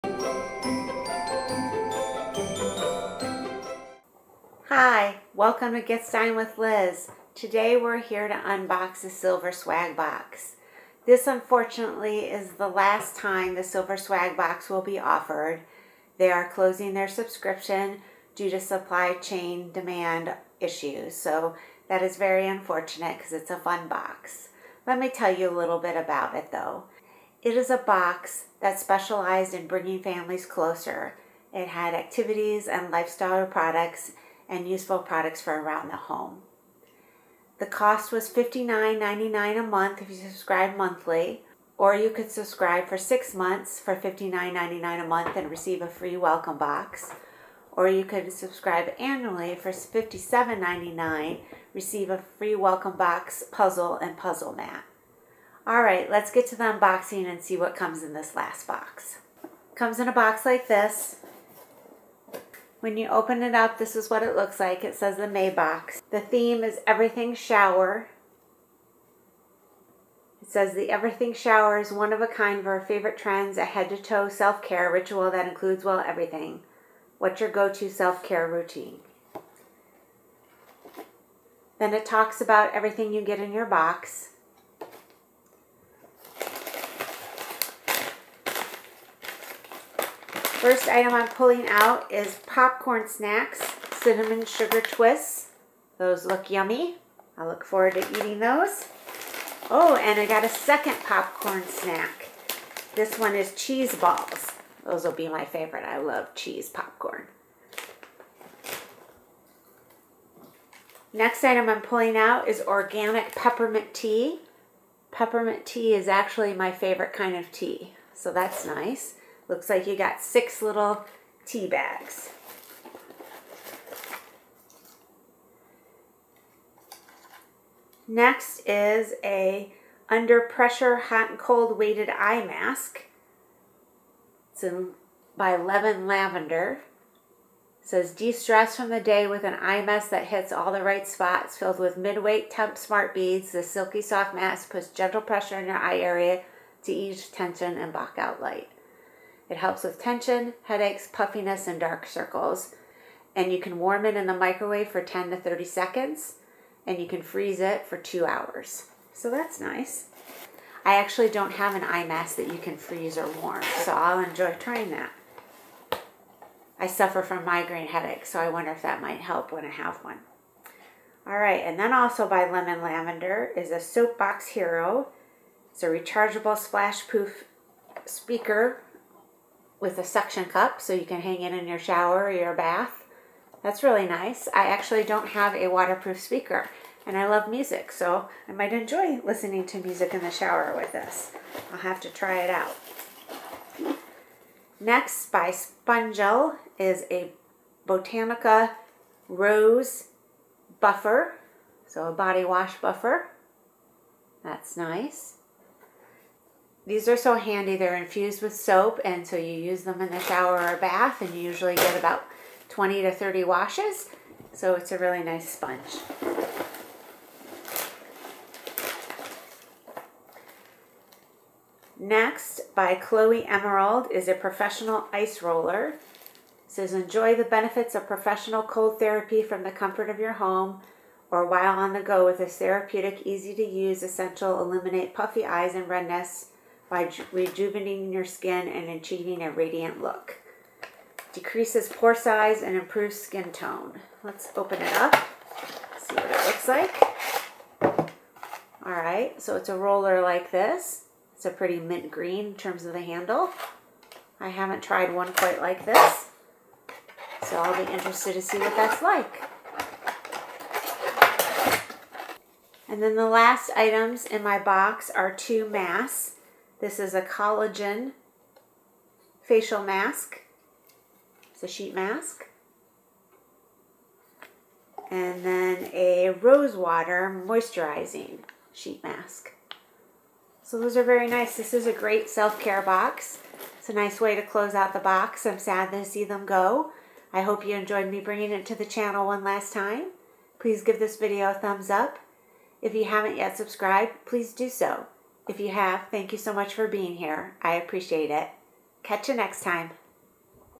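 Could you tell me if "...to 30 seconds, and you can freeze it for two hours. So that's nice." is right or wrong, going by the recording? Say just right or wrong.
right.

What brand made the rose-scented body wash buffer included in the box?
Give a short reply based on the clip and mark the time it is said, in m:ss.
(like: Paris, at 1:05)
Spongel, at 3:15.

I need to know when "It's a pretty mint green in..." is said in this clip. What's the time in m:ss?
4:11.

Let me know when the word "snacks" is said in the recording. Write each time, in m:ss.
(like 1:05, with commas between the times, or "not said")
1:33, 1:41.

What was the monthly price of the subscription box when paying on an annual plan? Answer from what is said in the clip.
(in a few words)
$57.99.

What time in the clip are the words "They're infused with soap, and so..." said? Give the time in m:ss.
3:27.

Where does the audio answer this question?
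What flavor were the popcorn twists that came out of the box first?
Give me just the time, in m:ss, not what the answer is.
1:33.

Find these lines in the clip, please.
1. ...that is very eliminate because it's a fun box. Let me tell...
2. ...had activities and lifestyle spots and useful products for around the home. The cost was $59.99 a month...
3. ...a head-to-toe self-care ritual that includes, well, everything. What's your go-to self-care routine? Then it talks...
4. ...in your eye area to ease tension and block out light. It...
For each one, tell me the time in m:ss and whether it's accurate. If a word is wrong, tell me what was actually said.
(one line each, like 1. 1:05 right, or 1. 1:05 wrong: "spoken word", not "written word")
1. 0:21 wrong: "unfortunate", not "eliminate"
2. 0:31 wrong: "products", not "spots"
3. 1:13 right
4. 2:25 right.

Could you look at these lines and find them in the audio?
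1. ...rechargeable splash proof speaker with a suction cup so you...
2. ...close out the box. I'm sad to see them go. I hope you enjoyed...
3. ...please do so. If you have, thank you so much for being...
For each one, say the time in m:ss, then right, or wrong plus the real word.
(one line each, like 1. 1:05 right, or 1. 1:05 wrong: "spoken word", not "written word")
1. 2:55 right
2. 4:44 right
3. 4:54 right.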